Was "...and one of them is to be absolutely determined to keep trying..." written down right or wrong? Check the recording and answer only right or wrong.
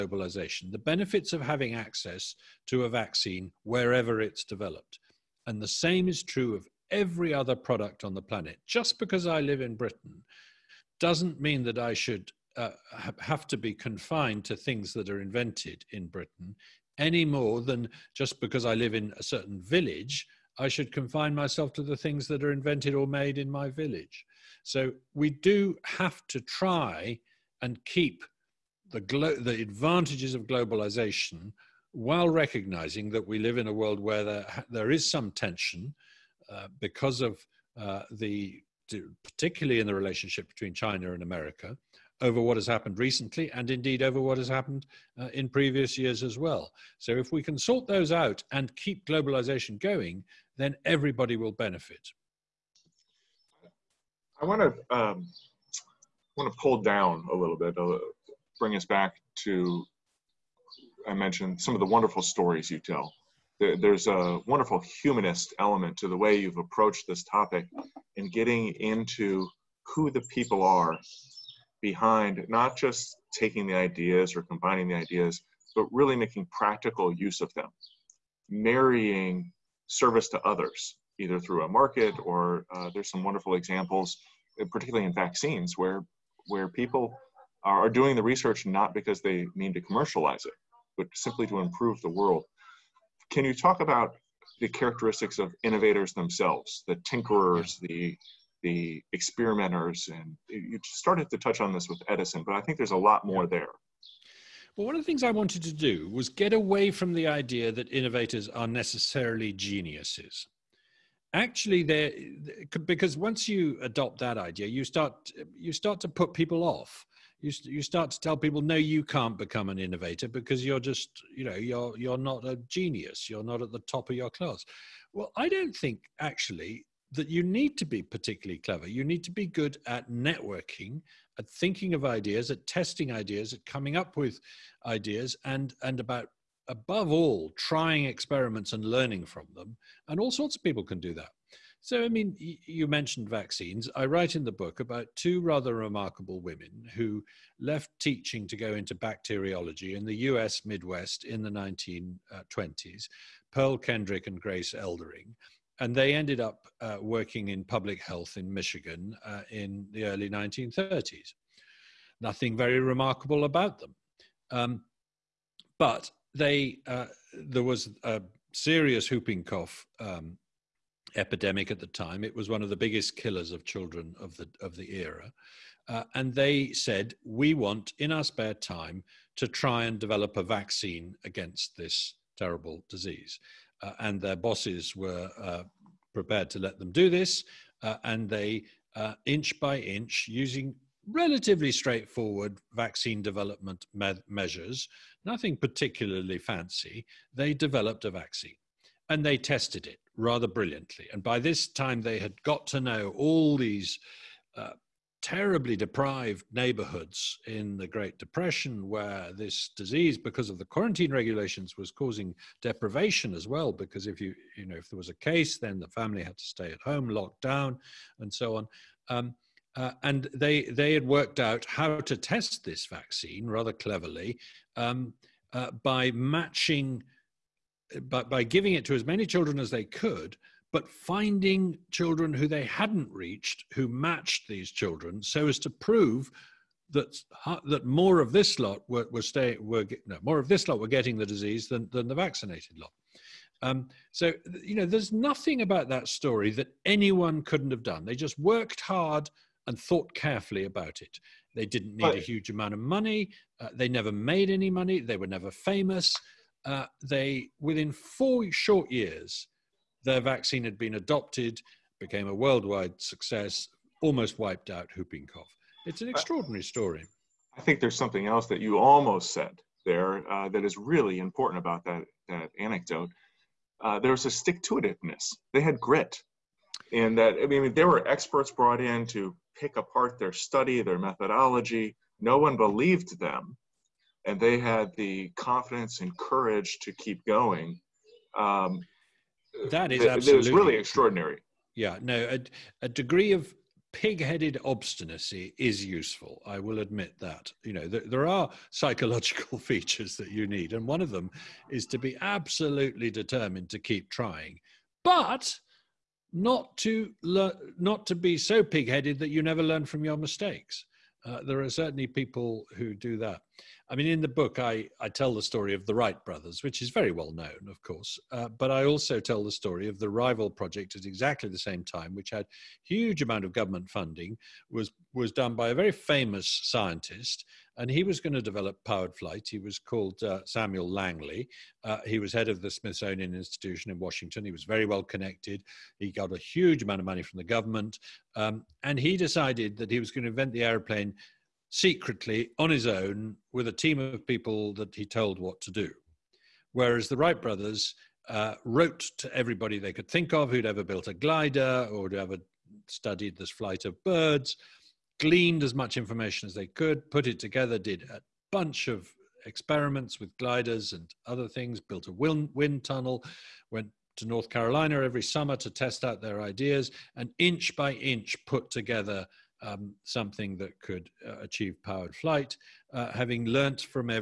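right.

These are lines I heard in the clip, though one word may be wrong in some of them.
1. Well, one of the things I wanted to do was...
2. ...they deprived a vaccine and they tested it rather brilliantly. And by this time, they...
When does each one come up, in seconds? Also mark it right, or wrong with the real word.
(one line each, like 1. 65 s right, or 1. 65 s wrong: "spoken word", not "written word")
1. 104 s right
2. 197 s wrong: "developed", not "deprived".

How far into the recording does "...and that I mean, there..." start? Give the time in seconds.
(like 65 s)
276 s.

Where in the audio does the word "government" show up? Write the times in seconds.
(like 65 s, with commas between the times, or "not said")
323 s, 337 s.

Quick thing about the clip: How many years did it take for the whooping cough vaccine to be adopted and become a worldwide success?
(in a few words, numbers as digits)
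4.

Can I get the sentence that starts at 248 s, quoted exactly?
They just worked hard and thought carefully about it.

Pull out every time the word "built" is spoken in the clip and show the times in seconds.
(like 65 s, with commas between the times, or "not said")
350 s, 361 s.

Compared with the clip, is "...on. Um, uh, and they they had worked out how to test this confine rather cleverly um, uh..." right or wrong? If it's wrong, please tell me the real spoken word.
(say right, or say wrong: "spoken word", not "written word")
wrong: "vaccine", not "confine".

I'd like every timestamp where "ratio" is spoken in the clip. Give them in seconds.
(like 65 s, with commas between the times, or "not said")
not said.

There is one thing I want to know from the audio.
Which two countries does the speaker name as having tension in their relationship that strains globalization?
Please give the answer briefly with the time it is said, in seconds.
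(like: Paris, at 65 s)
China and America, at 40 s.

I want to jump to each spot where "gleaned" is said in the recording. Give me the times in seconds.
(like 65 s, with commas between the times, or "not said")
355 s.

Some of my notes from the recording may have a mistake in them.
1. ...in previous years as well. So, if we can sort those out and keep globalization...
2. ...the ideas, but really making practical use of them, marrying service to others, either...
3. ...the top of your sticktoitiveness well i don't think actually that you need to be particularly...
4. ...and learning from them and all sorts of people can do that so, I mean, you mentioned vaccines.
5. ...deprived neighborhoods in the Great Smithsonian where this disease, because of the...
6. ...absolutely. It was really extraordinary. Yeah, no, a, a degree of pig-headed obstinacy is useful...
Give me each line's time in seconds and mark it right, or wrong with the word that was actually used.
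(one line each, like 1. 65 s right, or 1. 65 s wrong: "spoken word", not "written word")
1. 45 s right
2. 74 s right
3. 123 s wrong: "class", not "sticktoitiveness"
4. 138 s right
5. 205 s wrong: "Depression", not "Smithsonian"
6. 290 s right.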